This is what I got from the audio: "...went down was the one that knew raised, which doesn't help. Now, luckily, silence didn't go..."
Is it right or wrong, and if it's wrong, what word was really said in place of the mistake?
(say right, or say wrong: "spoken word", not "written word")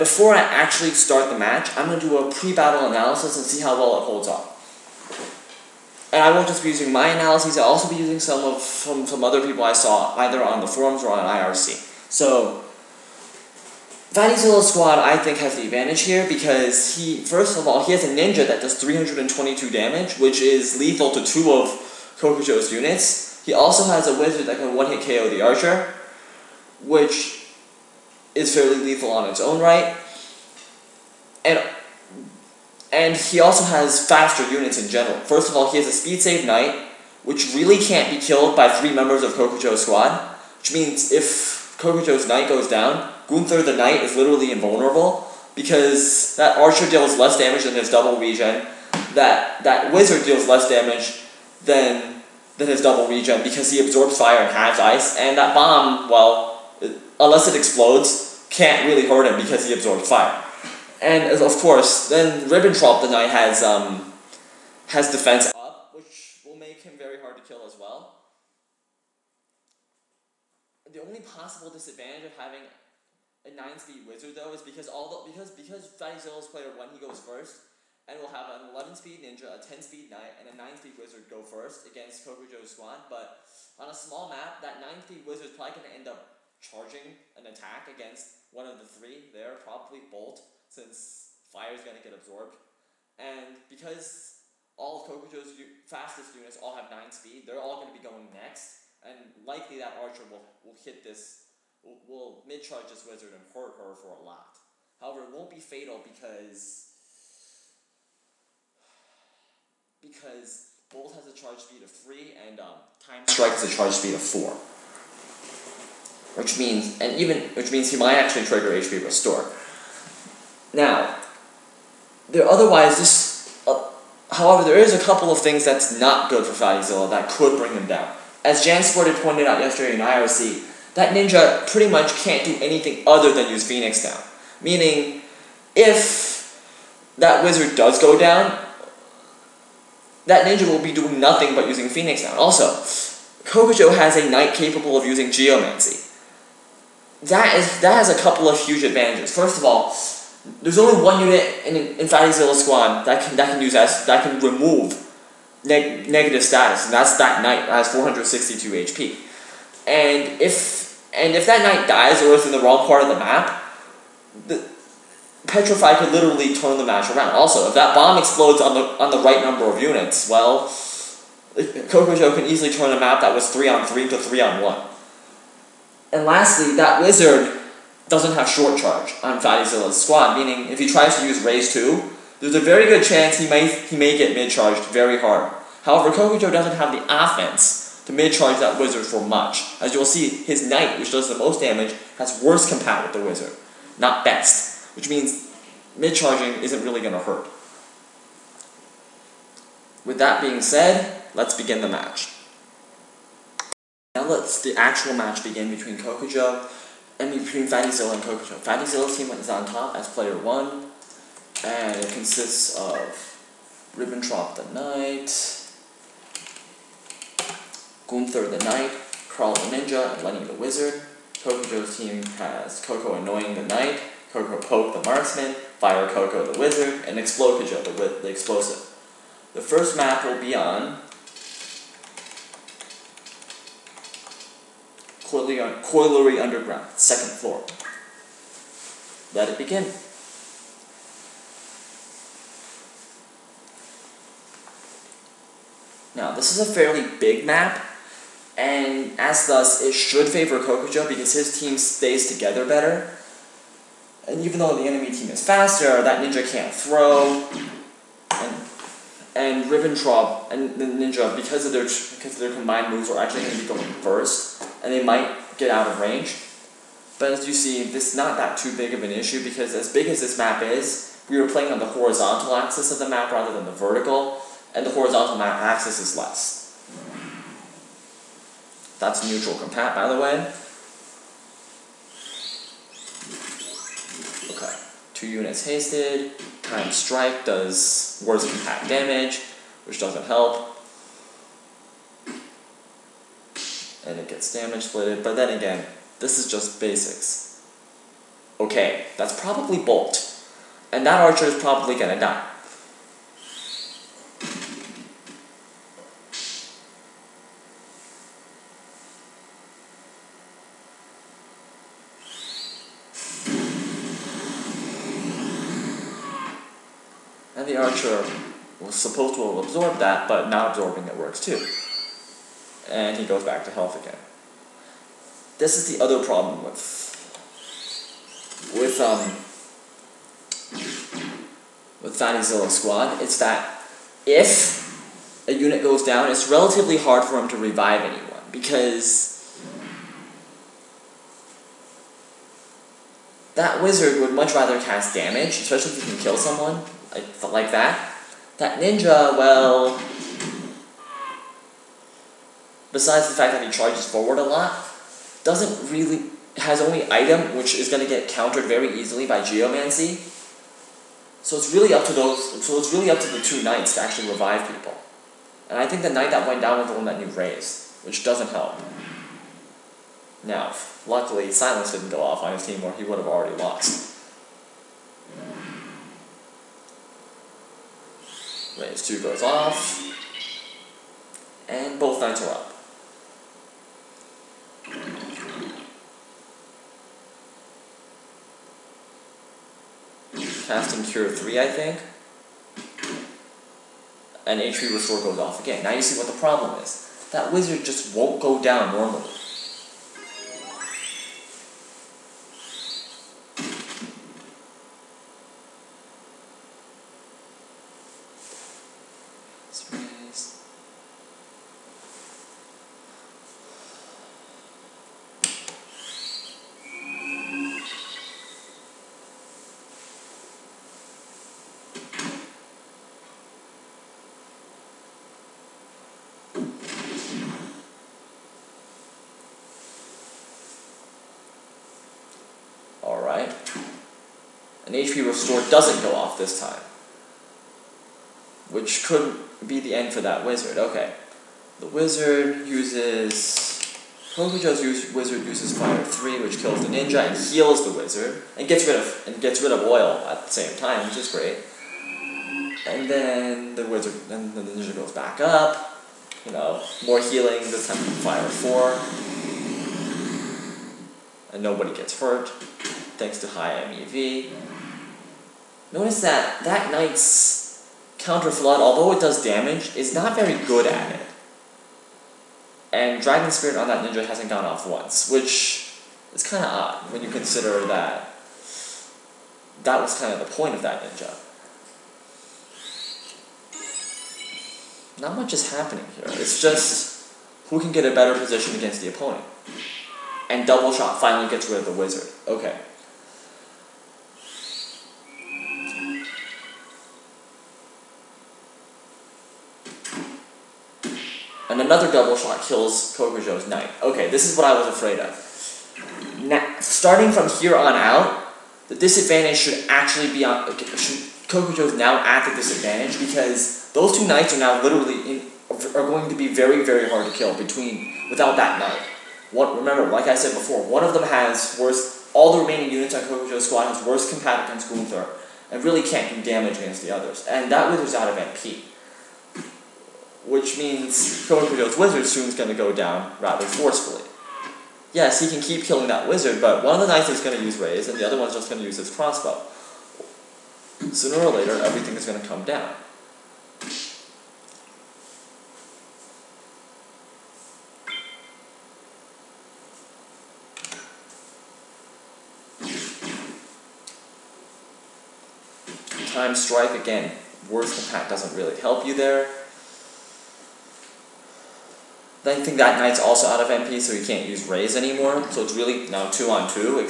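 right.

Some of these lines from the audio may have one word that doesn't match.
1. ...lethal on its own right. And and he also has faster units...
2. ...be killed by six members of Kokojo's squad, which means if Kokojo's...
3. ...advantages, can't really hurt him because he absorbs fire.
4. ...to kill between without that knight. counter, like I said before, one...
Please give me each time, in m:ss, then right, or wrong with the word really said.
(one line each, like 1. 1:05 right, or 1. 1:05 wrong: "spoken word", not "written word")
1. 0:28 right
2. 0:38 wrong: "three", not "six"
3. 0:57 wrong: "explodes", not "advantages"
4. 8:37 wrong: "remember", not "counter".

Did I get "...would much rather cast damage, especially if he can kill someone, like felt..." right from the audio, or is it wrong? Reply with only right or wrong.
right.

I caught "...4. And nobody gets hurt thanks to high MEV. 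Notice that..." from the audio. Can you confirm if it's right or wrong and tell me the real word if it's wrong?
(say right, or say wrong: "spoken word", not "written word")
right.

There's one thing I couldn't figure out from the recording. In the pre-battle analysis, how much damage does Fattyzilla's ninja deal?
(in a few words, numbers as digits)
322.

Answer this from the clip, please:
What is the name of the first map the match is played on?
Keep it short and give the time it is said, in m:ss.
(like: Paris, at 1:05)
Colliery Underground, at 3:55.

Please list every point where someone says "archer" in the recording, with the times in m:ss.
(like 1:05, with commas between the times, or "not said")
0:25, 0:46, 1:39, 5:01, 5:17.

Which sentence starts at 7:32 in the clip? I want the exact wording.
And then the wizard and the ninja goes back up.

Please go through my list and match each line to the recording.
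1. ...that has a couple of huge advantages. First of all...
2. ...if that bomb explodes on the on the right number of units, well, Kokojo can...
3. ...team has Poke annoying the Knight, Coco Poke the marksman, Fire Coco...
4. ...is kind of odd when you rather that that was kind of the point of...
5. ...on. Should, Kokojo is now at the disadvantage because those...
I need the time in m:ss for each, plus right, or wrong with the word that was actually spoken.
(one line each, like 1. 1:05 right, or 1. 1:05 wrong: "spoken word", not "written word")
1. 2:27 right
2. 2:47 right
3. 3:41 wrong: "Coco", not "Poke"
4. 7:56 wrong: "consider", not "rather"
5. 8:30 right.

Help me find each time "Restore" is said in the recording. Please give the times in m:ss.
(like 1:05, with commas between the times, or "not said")
1:59, 6:34, 7:15.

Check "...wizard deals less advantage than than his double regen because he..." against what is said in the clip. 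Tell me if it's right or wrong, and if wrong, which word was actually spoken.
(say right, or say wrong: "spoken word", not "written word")
wrong: "damage", not "advantage".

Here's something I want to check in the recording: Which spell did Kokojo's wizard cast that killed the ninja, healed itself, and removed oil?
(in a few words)
Fire 3.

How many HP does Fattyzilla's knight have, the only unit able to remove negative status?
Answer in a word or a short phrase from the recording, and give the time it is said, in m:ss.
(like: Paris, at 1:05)
462, at 2:37.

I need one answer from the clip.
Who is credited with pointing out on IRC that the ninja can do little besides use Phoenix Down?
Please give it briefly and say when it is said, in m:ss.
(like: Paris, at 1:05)
Jan Sported, at 2:08.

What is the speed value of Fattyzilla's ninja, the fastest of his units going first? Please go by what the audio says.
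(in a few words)
11.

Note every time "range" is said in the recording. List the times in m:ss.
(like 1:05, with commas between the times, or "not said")
4:25, 6:18.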